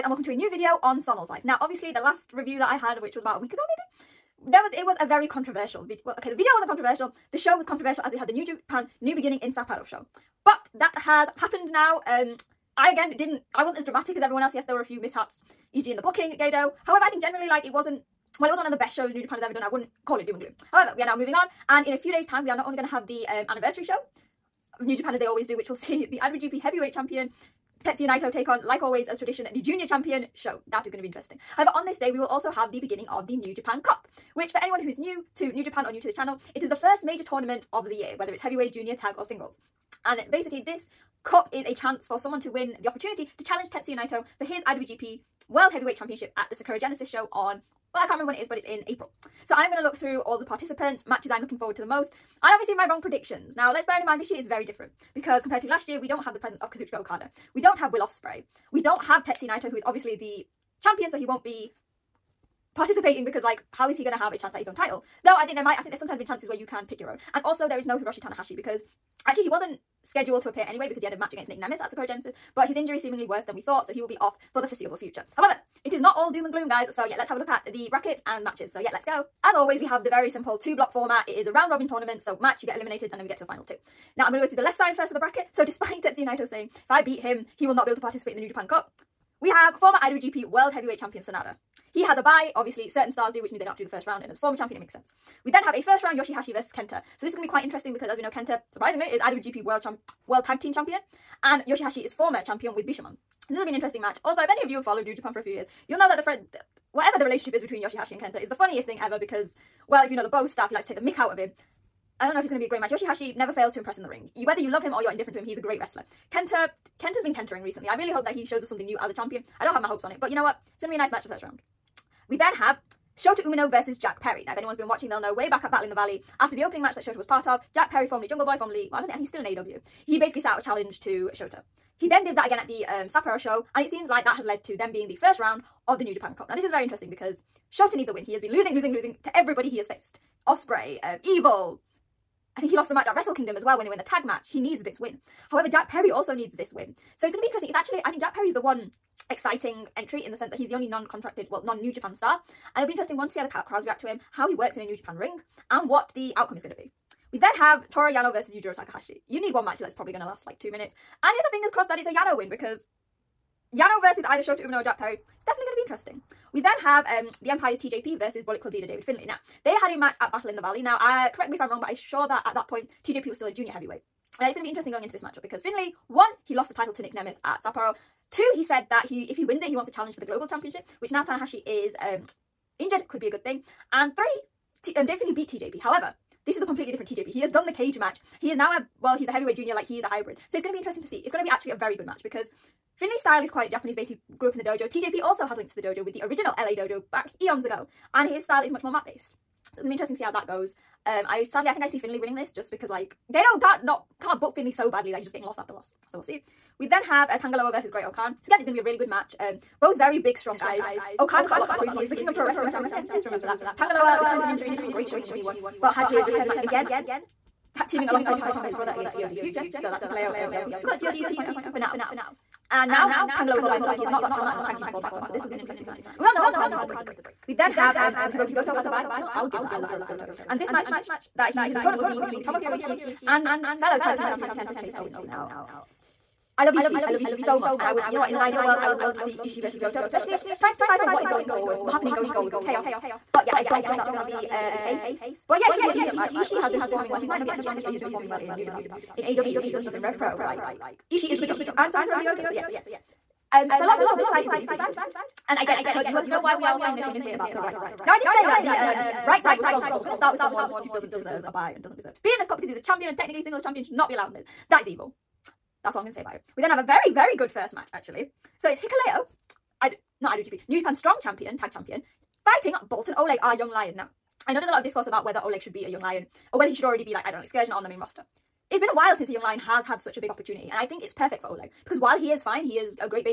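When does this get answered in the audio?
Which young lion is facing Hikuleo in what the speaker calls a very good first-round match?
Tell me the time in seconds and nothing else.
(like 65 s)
272 s.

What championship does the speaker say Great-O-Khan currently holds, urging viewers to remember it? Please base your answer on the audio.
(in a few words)
King of pro wrestling.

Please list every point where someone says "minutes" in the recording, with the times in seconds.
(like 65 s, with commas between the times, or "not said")
160 s.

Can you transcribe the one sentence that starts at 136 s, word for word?
Now this is very interesting because Shota needs a win.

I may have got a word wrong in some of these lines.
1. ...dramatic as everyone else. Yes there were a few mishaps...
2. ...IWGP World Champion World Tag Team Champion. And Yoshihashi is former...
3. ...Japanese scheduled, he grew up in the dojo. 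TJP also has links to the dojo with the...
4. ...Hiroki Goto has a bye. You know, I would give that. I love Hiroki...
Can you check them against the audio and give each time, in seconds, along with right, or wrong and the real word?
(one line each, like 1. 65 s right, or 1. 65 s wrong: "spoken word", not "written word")
1. 13 s right
2. 99 s right
3. 193 s wrong: "based", not "scheduled"
4. 228 s right.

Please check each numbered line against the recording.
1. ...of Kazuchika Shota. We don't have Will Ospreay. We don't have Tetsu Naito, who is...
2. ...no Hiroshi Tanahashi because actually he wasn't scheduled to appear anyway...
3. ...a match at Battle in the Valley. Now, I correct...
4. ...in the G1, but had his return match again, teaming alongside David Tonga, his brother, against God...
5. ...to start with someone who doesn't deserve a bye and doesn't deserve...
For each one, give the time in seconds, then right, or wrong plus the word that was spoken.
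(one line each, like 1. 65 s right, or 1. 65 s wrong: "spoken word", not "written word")
1. 56 s wrong: "Okada", not "Shota"
2. 67 s right
3. 169 s right
4. 215 s wrong: "Tama", not "David"
5. 260 s right.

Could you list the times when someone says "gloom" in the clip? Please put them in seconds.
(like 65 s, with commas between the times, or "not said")
20 s, 76 s.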